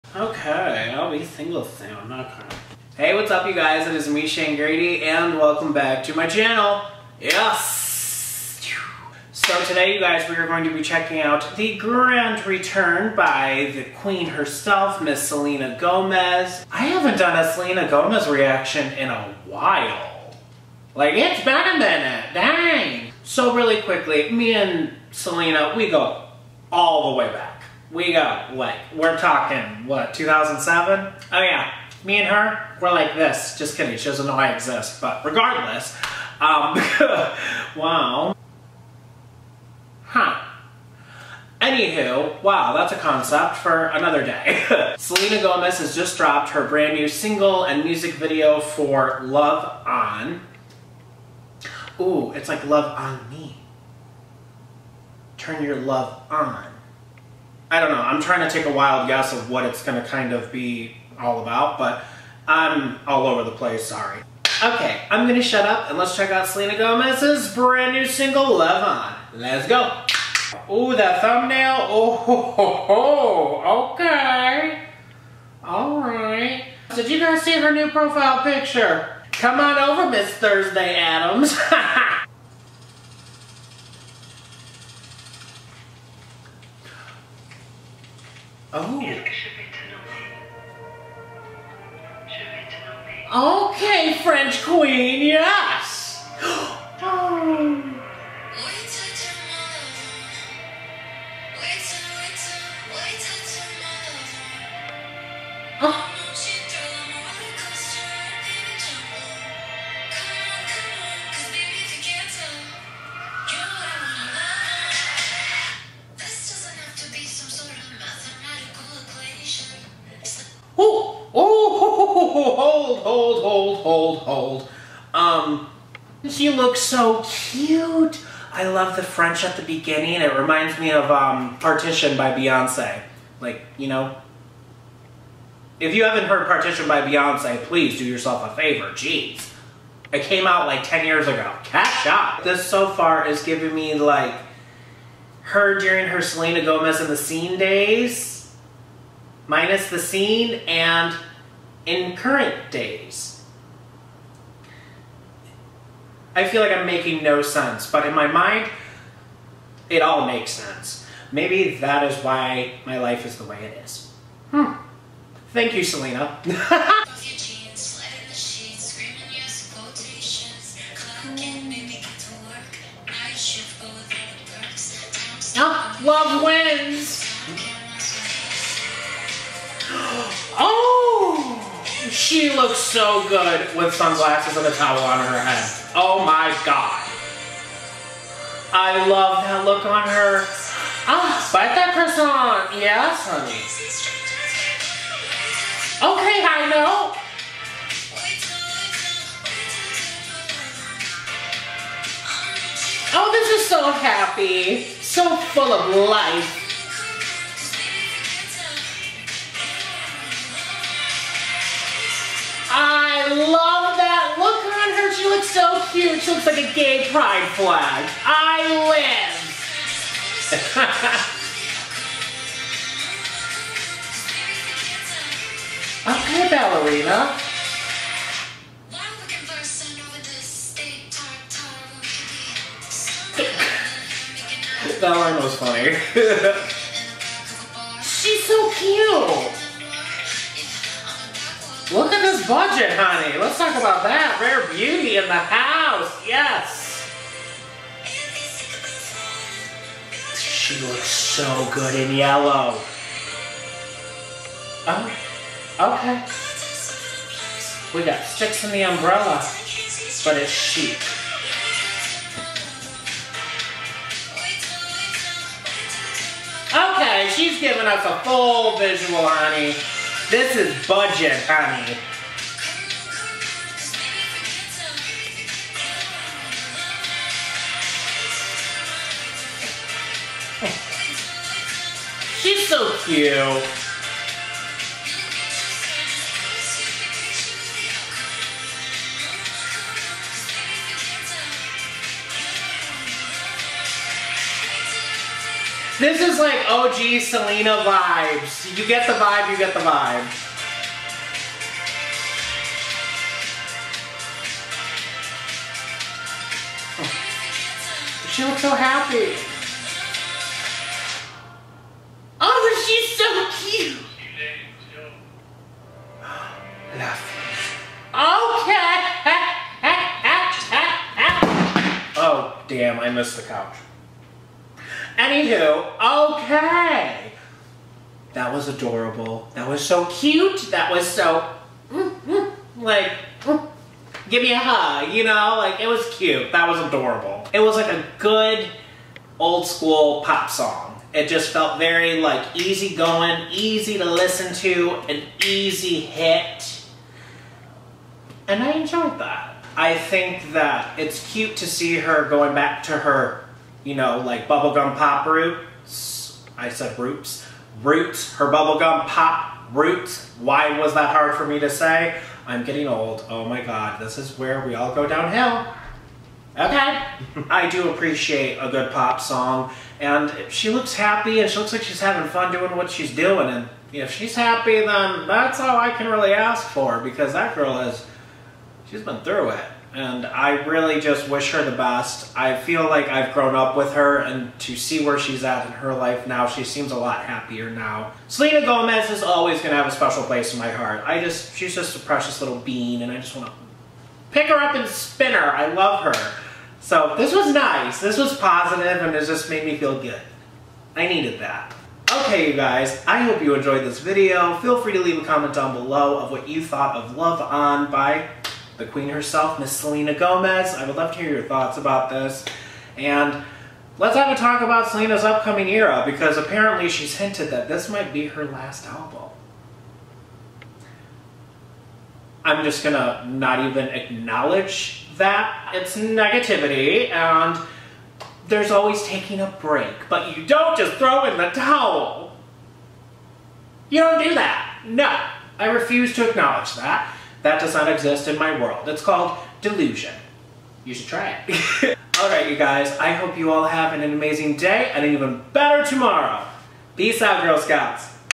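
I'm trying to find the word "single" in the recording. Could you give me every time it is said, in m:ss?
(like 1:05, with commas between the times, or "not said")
0:01, 0:47, 1:08.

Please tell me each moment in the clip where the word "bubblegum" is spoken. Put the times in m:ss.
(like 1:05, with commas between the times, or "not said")
5:54, 5:58.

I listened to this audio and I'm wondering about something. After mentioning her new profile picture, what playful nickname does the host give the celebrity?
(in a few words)
Miss Thursday Adams.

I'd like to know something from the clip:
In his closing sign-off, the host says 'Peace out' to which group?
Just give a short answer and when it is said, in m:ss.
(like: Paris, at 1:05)
Girl Scouts, at 7:27.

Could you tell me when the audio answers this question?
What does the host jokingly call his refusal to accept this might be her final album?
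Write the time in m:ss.
7:19.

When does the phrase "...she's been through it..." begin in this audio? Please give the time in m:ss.
6:18.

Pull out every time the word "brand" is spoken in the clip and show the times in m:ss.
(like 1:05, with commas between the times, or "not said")
0:46, 1:07.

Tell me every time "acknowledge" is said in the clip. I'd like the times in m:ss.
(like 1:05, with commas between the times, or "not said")
7:03, 7:16.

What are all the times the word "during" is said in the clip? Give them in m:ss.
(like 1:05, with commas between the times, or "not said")
2:25.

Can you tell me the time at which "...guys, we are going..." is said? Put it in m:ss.
0:10.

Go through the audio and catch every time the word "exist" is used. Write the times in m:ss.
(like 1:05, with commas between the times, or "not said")
0:34, 7:17.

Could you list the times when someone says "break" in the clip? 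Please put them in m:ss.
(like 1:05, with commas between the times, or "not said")
7:09.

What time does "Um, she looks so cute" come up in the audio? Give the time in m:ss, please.
2:05.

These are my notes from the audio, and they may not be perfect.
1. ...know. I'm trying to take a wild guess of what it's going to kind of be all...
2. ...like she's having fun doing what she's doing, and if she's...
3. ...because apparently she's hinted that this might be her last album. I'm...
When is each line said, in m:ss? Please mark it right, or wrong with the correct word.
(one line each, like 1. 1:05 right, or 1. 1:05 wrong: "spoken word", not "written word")
1. 0:57 right
2. 6:11 right
3. 6:56 right.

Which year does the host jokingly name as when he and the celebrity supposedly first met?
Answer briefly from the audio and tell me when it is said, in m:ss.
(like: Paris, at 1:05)
2007, at 0:30.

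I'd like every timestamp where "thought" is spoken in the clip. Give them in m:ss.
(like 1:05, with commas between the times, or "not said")
6:46, 6:51.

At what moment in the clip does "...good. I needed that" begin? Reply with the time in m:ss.
6:40.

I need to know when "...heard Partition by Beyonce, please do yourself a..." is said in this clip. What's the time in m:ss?
2:16.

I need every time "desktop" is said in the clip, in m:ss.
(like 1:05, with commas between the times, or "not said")
not said.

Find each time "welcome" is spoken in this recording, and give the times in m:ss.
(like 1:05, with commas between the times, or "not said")
0:05.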